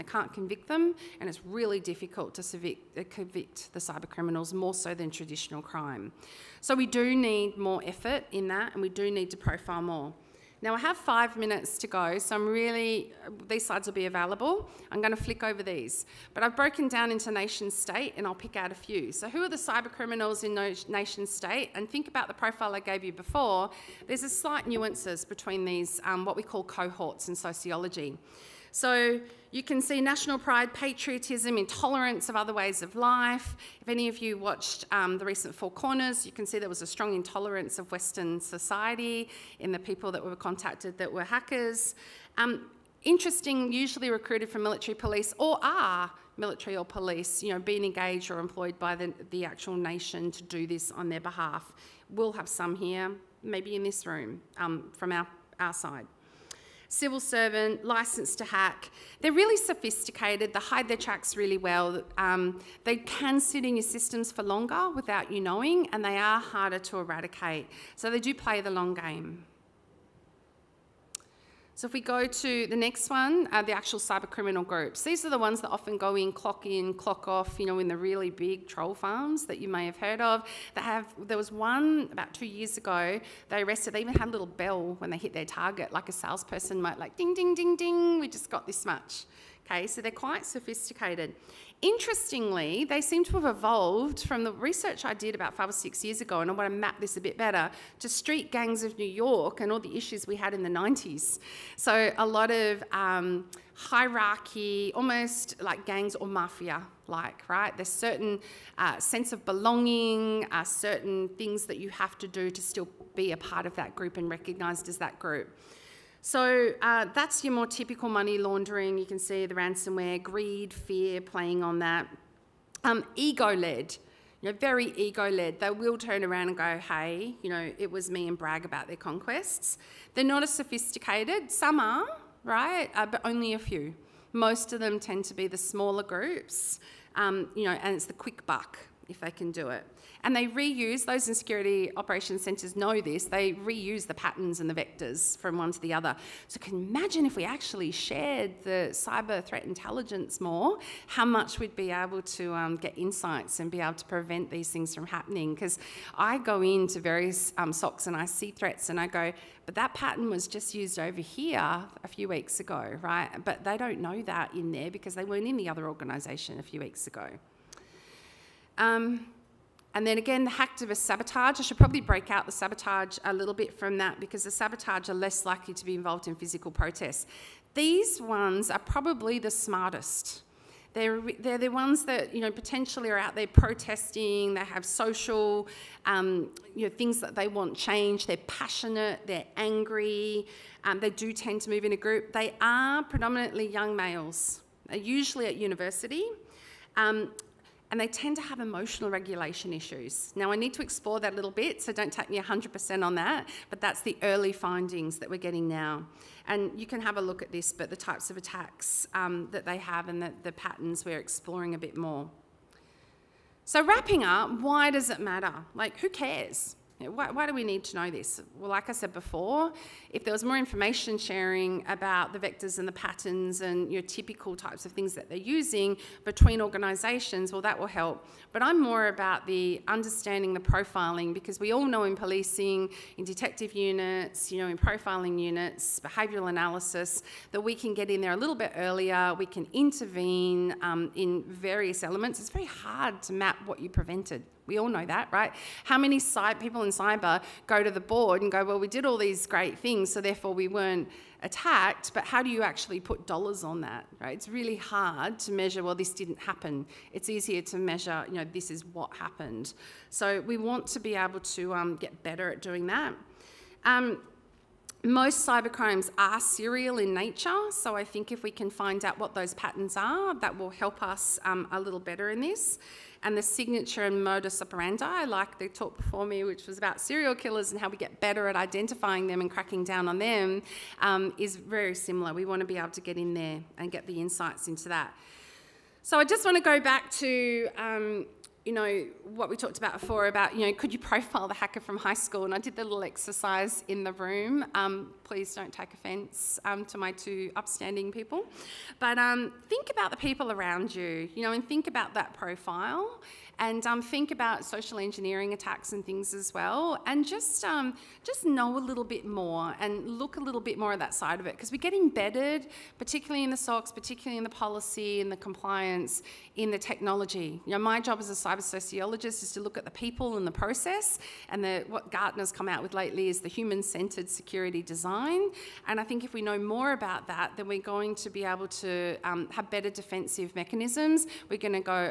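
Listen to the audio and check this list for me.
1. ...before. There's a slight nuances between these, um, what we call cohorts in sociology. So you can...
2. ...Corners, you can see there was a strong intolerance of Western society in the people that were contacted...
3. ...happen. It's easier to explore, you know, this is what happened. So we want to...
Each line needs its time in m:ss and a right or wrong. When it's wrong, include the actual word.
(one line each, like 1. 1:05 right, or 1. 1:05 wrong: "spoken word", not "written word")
1. 0:23 right
2. 0:35 right
3. 4:16 wrong: "measure", not "explore".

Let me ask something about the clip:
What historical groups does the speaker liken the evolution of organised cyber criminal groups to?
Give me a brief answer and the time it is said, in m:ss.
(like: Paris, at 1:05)
Street gangs of New York, at 1:38.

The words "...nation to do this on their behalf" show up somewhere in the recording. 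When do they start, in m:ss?
0:49.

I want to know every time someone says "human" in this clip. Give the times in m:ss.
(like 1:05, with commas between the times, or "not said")
5:23.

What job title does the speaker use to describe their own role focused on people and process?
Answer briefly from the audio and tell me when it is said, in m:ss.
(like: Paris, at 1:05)
Cyber sociologist, at 5:18.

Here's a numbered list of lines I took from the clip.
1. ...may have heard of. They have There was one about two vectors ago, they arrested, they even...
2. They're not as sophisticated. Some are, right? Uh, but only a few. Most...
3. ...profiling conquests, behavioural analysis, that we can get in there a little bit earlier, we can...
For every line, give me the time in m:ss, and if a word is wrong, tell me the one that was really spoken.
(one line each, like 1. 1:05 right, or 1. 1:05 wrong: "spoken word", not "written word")
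1. 1:19 wrong: "years", not "vectors"
2. 2:10 right
3. 3:54 wrong: "units", not "conquests".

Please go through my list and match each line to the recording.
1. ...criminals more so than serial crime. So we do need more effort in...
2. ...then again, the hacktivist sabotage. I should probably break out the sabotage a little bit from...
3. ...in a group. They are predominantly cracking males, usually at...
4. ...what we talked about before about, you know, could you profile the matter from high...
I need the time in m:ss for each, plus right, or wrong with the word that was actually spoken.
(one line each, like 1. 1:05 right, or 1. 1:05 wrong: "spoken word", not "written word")
1. 0:04 wrong: "traditional", not "serial"
2. 2:50 right
3. 3:11 wrong: "young", not "cracking"
4. 4:49 wrong: "hacker", not "matter".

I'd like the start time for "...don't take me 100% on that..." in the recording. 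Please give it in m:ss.
3:21.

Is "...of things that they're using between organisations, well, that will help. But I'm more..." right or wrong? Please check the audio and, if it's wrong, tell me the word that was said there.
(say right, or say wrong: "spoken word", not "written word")
right.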